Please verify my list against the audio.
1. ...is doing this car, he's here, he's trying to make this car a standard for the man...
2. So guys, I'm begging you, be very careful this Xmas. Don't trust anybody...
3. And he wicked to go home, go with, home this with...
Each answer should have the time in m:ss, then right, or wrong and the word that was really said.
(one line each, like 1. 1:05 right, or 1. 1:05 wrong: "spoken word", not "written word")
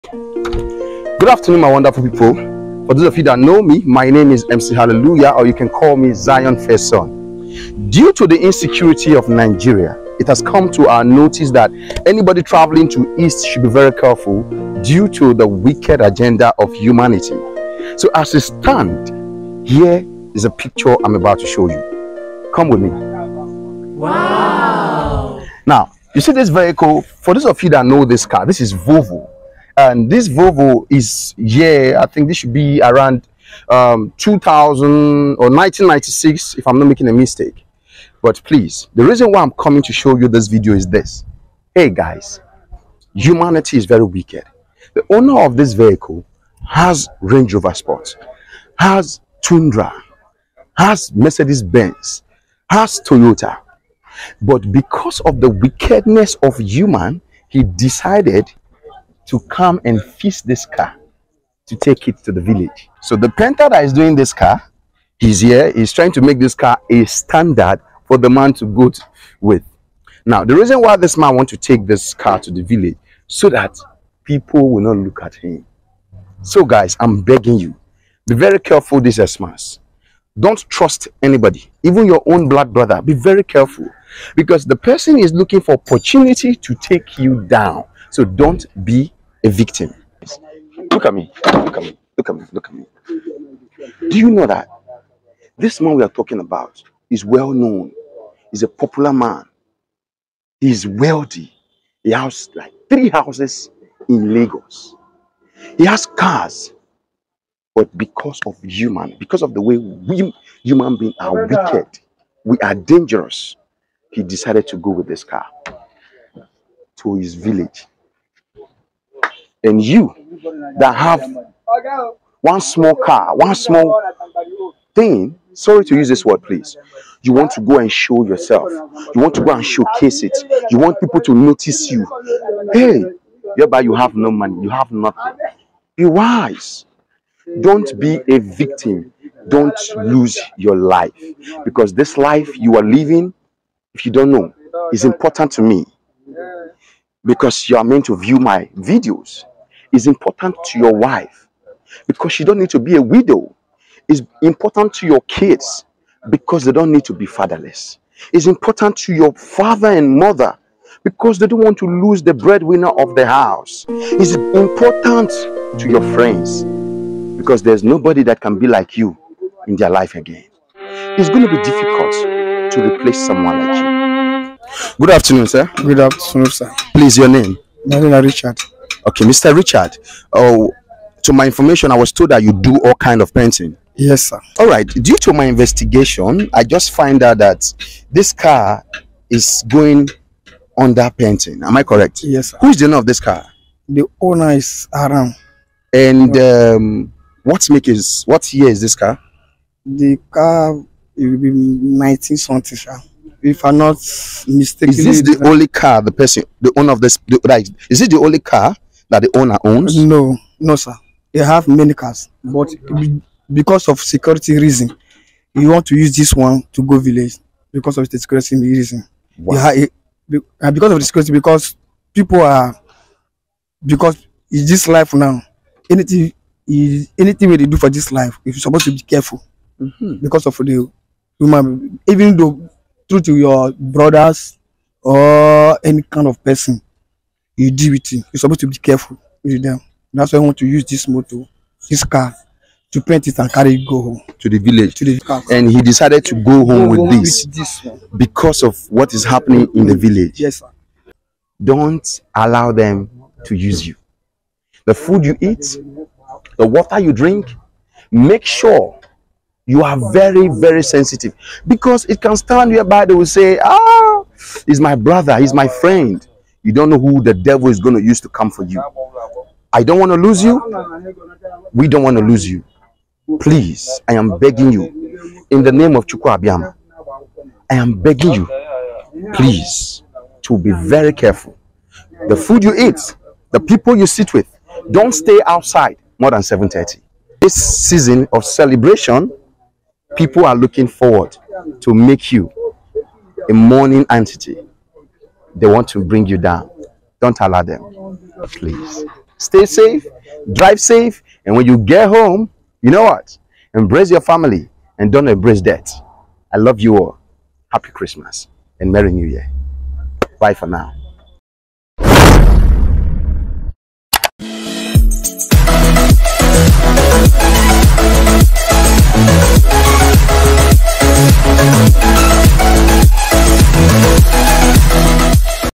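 1. 1:03 right
2. 1:16 right
3. 4:05 wrong: "decided", not "wicked".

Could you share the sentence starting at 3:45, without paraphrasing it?
Anything is anything we do for this life, if you're supposed to be careful mm -hmm.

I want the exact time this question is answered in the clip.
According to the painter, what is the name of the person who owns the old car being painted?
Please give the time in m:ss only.
3:13.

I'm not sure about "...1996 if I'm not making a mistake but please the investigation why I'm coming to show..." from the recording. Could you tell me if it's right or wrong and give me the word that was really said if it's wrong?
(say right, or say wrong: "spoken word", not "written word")
wrong: "reason", not "investigation".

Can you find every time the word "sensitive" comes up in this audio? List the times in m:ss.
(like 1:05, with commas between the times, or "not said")
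4:20.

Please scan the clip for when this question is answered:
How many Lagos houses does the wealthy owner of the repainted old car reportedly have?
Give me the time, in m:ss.
1:42.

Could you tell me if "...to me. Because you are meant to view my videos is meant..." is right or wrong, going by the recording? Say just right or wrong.
wrong.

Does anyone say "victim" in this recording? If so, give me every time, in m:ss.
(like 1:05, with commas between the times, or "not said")
1:29, 2:18.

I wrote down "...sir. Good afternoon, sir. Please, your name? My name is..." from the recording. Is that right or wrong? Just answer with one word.
right.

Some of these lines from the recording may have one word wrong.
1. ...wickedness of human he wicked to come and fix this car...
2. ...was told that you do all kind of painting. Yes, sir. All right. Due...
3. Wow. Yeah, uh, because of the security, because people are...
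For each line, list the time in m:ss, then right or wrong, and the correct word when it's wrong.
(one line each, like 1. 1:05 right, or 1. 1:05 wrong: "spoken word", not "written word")
1. 0:55 wrong: "decided", not "wicked"
2. 3:01 right
3. 3:39 right.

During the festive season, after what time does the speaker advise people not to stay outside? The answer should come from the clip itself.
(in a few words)
7:30.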